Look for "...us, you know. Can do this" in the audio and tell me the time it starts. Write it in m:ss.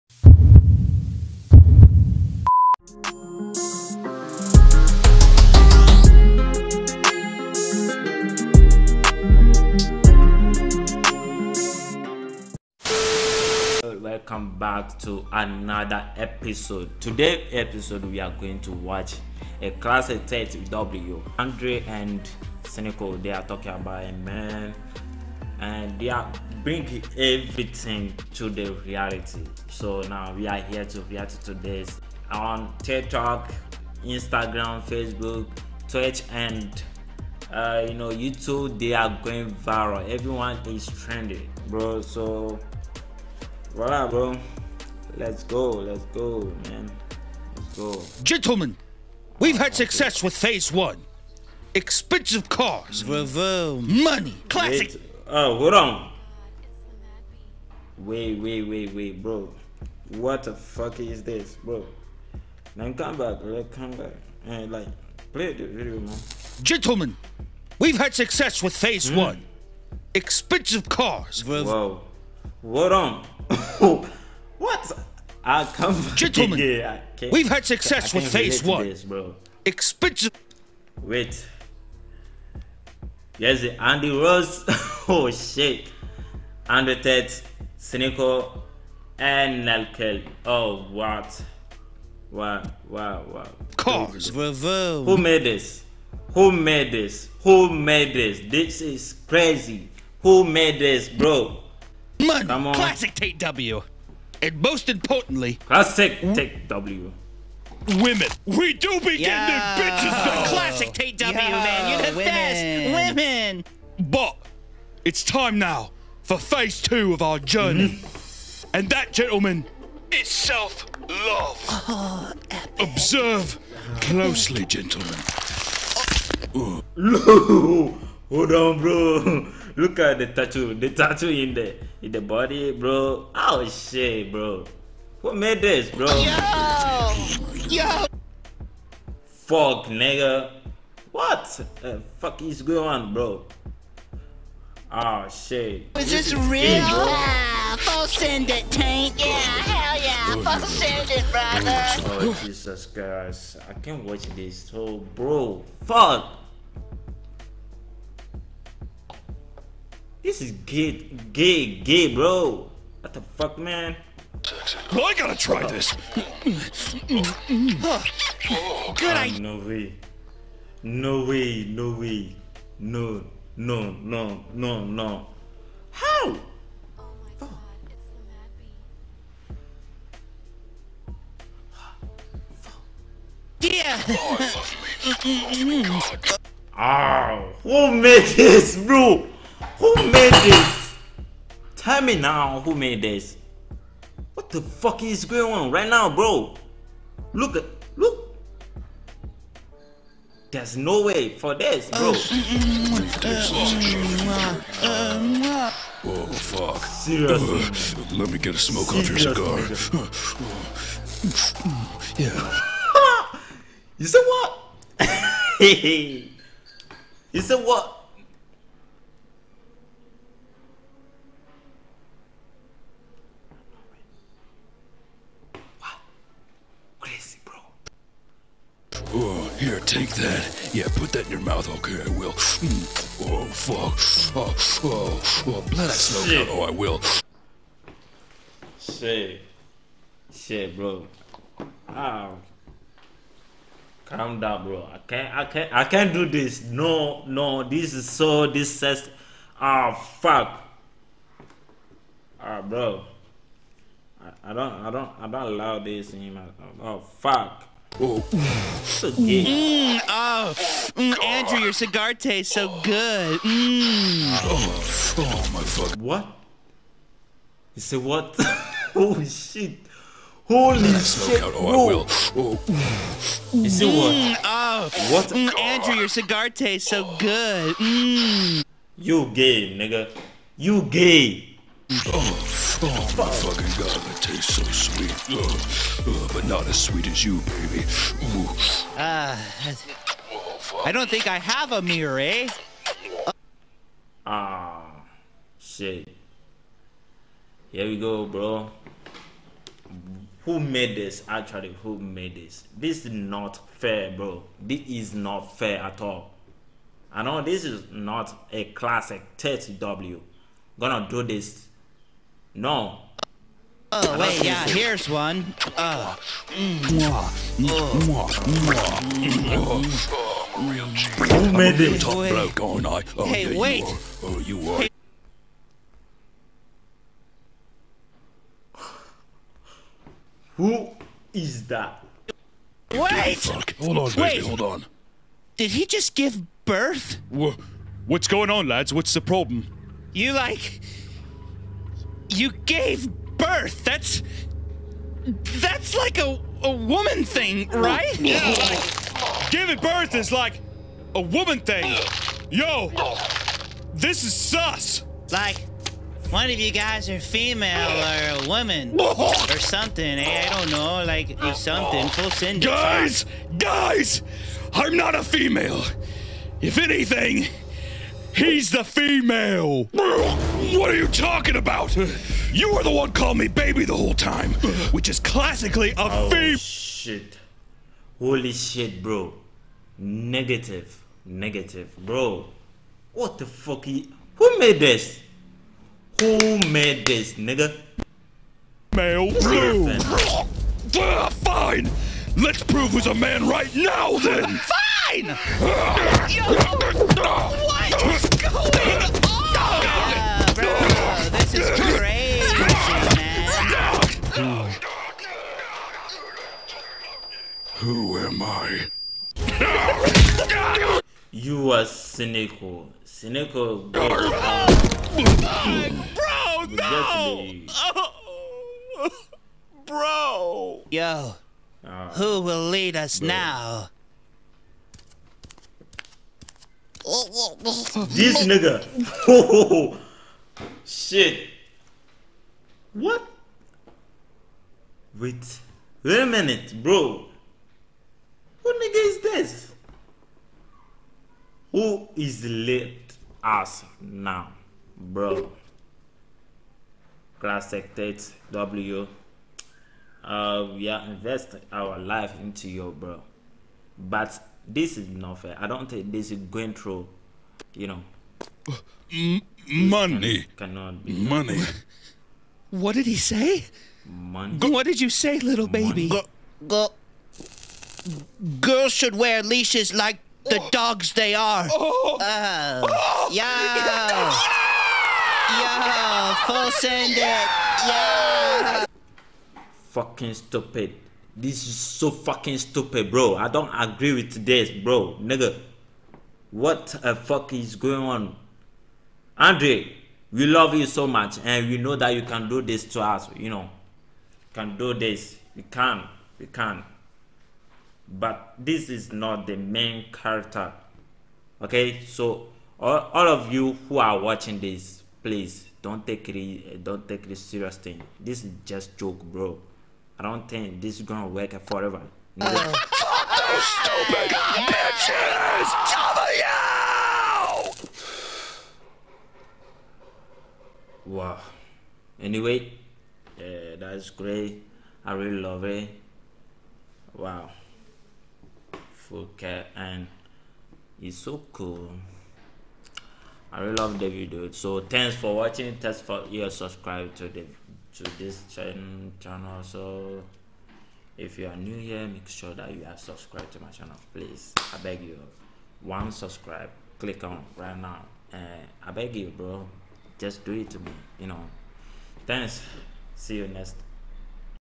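8:13.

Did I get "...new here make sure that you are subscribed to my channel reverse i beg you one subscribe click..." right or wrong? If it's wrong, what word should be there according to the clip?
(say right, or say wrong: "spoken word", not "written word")
wrong: "please", not "reverse".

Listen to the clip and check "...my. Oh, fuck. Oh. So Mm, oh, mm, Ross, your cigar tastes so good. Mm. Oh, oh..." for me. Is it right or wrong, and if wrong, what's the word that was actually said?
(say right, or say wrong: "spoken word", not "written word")
wrong: "Andrew", not "Ross".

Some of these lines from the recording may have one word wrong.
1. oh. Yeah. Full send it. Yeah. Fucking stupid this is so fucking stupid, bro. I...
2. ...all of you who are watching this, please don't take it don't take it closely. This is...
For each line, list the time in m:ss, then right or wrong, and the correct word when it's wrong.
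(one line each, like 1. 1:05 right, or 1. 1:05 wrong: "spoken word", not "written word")
1. 7:52 right
2. 8:23 wrong: "seriously", not "closely".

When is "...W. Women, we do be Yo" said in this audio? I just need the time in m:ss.
1:46.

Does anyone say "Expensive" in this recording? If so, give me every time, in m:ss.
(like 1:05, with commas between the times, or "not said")
0:51, 1:10, 1:19.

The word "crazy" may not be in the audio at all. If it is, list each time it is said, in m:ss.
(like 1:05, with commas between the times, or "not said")
1:39.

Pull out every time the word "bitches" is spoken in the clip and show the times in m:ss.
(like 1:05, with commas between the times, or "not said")
1:49, 8:34.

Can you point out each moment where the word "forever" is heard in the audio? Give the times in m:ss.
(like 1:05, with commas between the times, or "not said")
8:31.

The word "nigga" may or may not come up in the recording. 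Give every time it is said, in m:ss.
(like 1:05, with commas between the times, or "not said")
2:19, 4:39, 6:27, 7:08, 7:18, 8:05.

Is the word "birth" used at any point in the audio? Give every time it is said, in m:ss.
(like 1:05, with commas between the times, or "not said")
5:36, 5:43, 5:49.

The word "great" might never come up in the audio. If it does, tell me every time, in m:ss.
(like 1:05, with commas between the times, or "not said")
8:44.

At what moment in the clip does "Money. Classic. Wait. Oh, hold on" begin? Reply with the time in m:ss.
0:54.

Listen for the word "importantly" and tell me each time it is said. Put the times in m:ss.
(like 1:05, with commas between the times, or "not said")
1:44.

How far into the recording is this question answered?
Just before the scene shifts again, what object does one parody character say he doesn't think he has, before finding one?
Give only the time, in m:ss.
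4:51.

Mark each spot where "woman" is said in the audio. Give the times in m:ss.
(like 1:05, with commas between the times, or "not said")
5:46, 5:51, 5:58.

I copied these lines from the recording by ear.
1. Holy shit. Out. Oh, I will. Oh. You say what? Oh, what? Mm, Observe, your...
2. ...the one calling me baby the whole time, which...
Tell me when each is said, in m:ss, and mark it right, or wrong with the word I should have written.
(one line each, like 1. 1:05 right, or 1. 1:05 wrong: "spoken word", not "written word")
1. 4:30 wrong: "Andrew", not "Observe"
2. 6:12 right.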